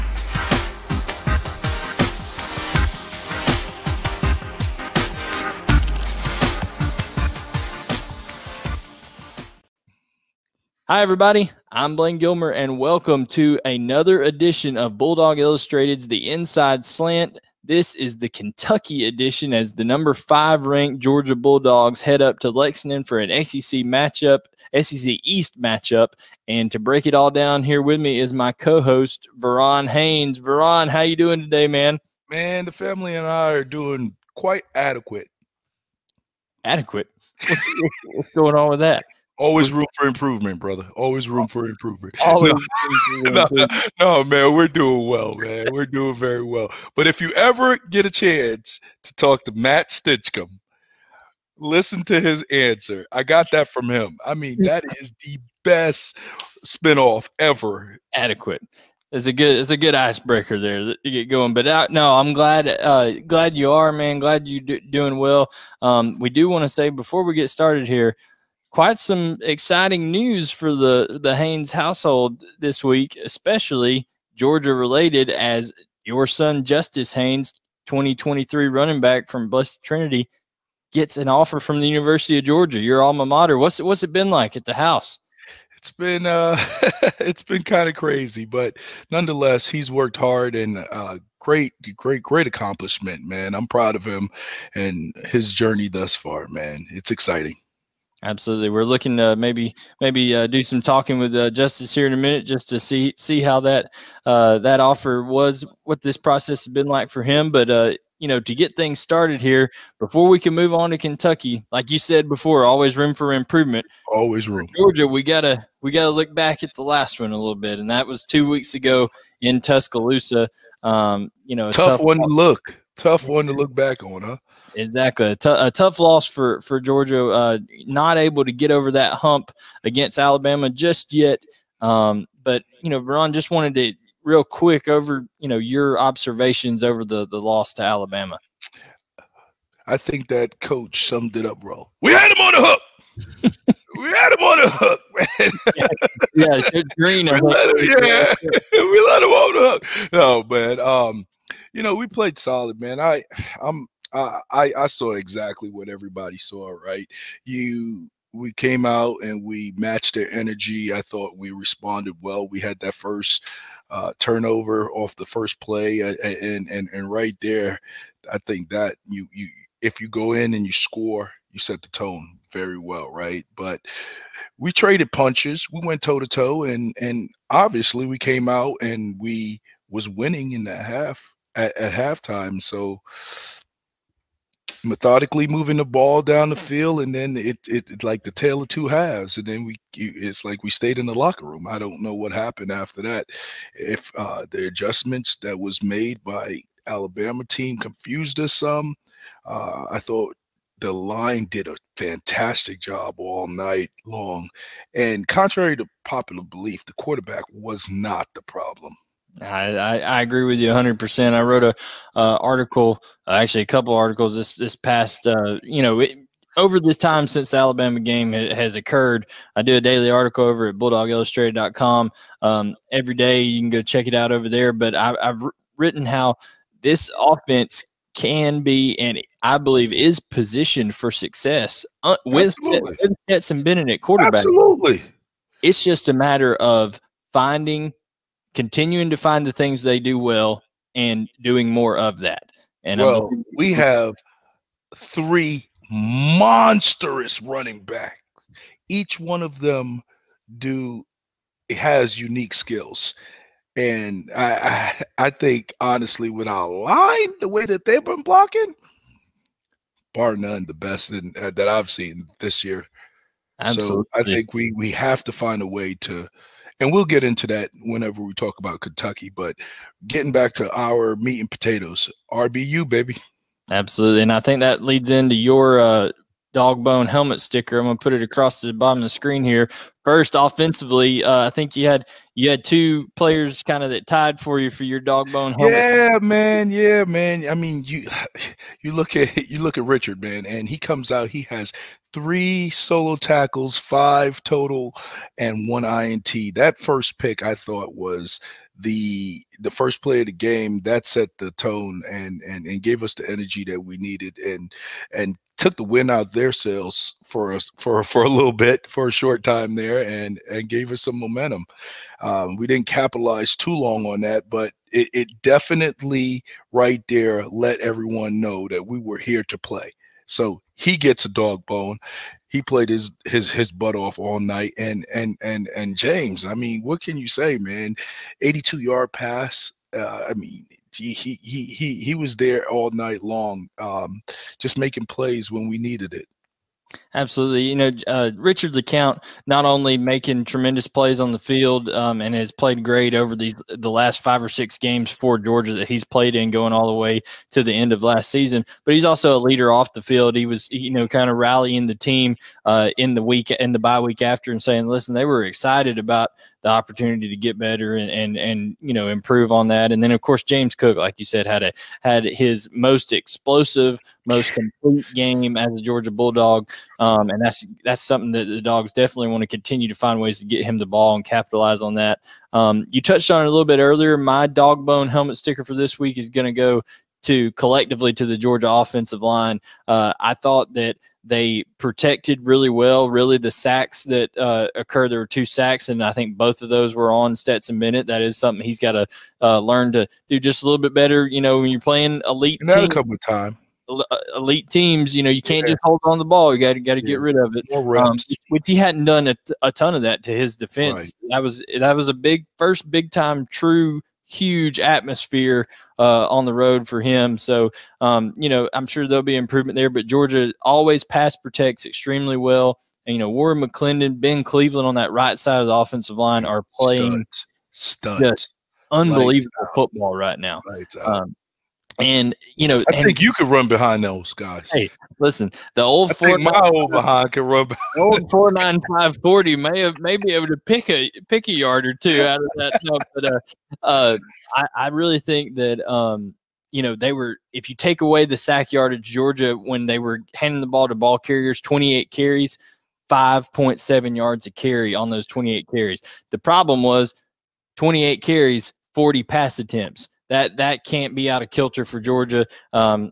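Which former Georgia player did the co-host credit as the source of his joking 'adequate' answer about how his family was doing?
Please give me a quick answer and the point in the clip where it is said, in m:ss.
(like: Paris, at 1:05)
Matt Stinchcomb, at 0:49.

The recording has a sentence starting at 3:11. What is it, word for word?
I don't know what happened after that.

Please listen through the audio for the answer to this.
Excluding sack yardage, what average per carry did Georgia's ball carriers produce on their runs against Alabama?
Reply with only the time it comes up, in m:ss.
7:23.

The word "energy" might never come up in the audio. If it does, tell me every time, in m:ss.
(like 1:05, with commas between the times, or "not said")
2:40, 5:03.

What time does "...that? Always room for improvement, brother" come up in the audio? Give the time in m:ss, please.
0:38.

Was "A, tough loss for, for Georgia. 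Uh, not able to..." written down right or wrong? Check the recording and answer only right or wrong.
right.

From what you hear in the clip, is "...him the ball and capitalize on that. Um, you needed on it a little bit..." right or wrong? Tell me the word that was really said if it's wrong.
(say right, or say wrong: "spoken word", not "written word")
wrong: "touched", not "needed".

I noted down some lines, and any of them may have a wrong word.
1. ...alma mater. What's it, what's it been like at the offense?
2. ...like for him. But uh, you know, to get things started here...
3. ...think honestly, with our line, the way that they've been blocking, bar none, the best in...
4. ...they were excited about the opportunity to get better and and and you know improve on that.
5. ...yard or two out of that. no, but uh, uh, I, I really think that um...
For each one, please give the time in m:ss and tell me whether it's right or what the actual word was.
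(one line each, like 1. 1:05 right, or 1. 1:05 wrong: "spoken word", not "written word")
1. 1:23 wrong: "house", not "offense"
2. 1:46 right
3. 4:15 right
4. 5:55 right
5. 7:11 right.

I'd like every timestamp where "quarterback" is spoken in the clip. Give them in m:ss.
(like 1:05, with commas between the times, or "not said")
3:26, 3:53.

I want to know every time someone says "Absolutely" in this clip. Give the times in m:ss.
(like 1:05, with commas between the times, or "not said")
1:38, 3:54, 4:23, 4:33, 5:37.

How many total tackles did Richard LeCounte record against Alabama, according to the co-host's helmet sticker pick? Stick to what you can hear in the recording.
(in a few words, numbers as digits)
5.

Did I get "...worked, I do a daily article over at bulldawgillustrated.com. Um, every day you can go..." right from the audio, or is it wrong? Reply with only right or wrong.
wrong.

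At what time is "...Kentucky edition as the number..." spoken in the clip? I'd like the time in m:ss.
0:18.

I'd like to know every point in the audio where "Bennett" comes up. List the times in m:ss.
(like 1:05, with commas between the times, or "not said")
3:53, 6:27.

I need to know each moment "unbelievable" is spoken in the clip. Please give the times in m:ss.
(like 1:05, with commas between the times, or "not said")
6:58.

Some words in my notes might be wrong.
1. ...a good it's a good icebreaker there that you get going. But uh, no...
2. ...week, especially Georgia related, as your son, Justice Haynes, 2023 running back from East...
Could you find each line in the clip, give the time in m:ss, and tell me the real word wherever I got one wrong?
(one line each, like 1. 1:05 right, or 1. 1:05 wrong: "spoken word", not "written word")
1. 0:59 right
2. 1:12 wrong: "Blessed", not "East".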